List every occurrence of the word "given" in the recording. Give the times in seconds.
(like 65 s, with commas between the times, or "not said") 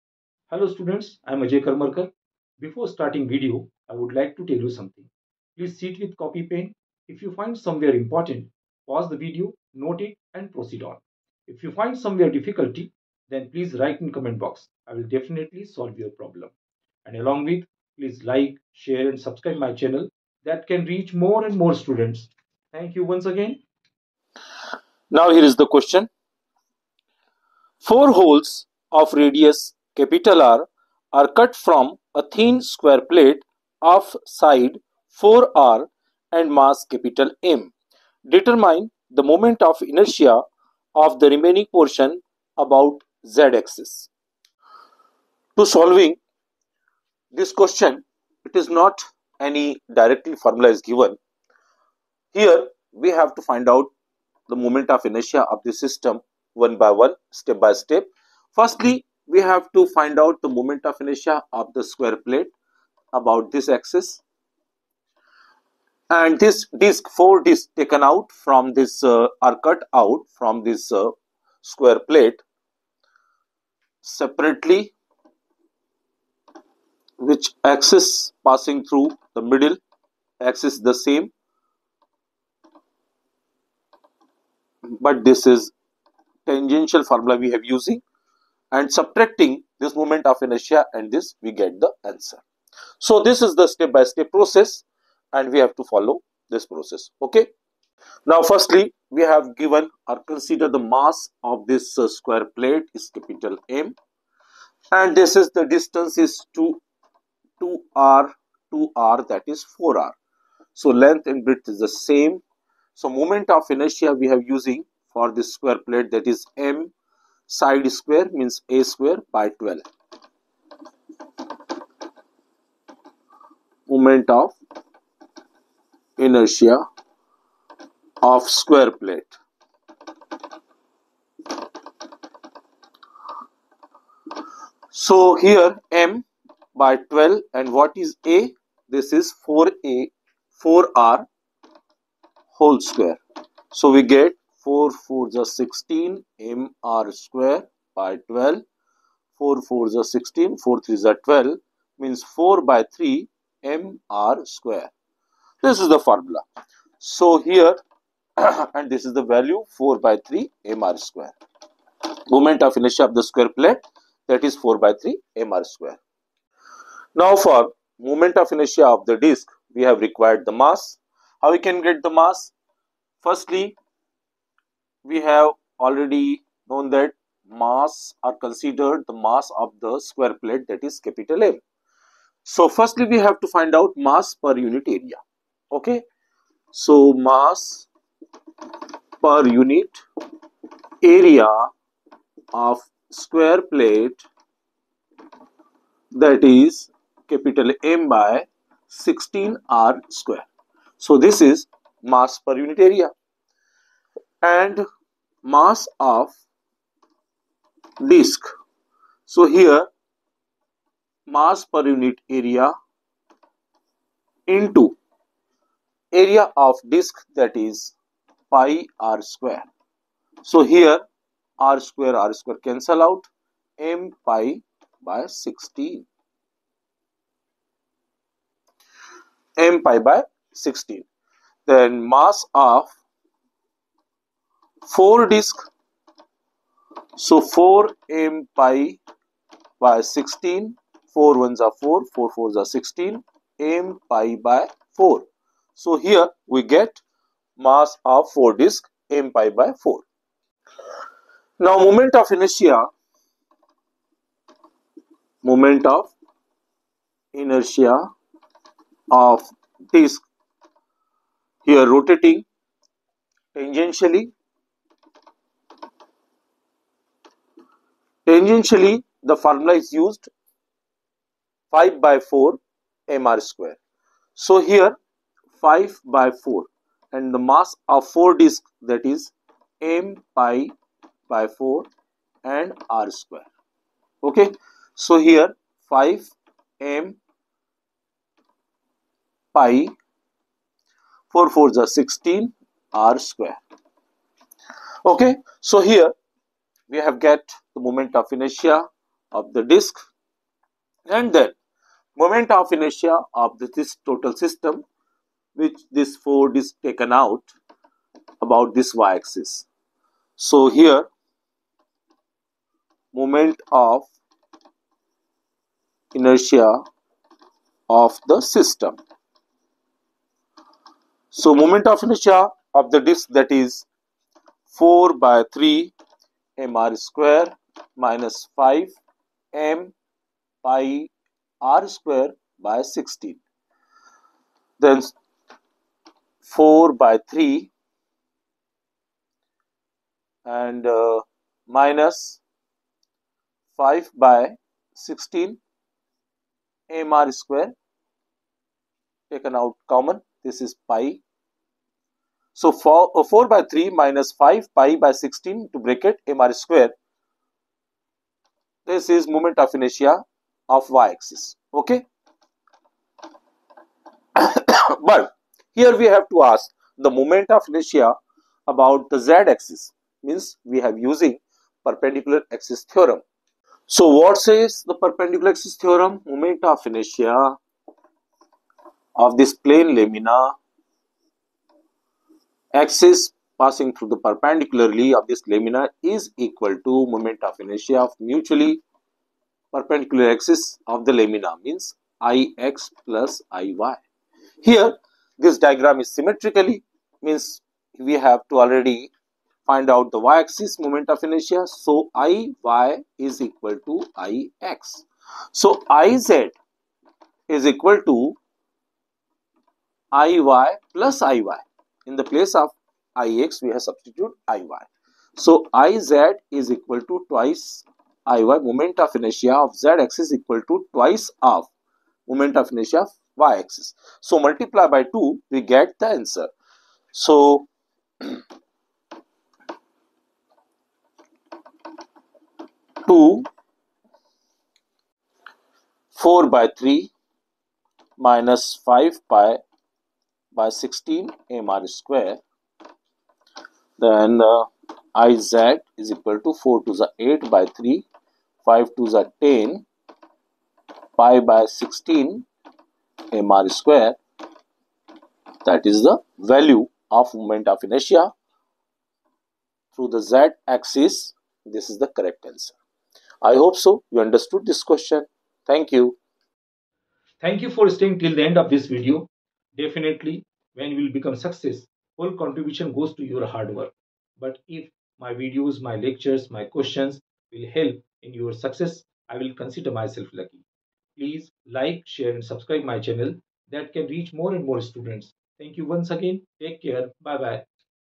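50 s, 99 s.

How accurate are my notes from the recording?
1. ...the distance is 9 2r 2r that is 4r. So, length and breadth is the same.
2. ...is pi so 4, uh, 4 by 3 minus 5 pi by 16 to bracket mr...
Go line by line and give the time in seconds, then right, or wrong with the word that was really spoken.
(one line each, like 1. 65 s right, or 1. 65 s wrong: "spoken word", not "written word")
1. 105 s wrong: "2", not "9"
2. 350 s right.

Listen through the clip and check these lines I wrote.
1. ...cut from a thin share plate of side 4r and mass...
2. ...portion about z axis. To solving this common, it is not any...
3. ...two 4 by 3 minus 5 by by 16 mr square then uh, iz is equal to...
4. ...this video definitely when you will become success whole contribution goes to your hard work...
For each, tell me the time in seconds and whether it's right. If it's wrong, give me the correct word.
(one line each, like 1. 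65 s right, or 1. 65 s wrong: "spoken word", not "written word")
1. 31 s wrong: "square", not "share"
2. 41 s wrong: "question", not "common"
3. 433 s right
4. 468 s right.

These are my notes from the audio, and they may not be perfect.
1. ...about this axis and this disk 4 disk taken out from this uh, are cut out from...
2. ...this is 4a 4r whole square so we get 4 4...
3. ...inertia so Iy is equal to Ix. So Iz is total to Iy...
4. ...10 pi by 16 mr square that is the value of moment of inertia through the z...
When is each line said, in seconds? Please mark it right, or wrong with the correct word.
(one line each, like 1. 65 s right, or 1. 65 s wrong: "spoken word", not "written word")
1. 63 s right
2. 138 s right
3. 401 s wrong: "equal", not "total"
4. 449 s right.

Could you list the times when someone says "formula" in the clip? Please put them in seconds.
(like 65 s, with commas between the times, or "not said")
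50 s, 87 s, 156 s, 269 s.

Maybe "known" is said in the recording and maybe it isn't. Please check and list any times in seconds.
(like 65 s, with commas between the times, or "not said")
176 s.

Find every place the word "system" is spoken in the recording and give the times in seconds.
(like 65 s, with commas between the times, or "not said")
55 s, 304 s, 318 s.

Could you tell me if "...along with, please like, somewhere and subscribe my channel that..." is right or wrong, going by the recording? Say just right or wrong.
wrong.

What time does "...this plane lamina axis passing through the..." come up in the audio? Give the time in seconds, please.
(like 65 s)
379 s.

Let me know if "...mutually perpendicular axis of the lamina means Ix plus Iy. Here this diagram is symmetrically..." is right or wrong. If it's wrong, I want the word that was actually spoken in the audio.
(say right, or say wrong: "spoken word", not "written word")
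right.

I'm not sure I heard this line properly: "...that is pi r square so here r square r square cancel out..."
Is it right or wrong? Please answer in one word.
right.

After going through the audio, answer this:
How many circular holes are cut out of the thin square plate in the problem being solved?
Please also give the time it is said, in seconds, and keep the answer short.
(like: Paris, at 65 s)
4, at 27 s.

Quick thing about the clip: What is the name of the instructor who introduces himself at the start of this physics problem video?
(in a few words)
Ajay Karmarkar.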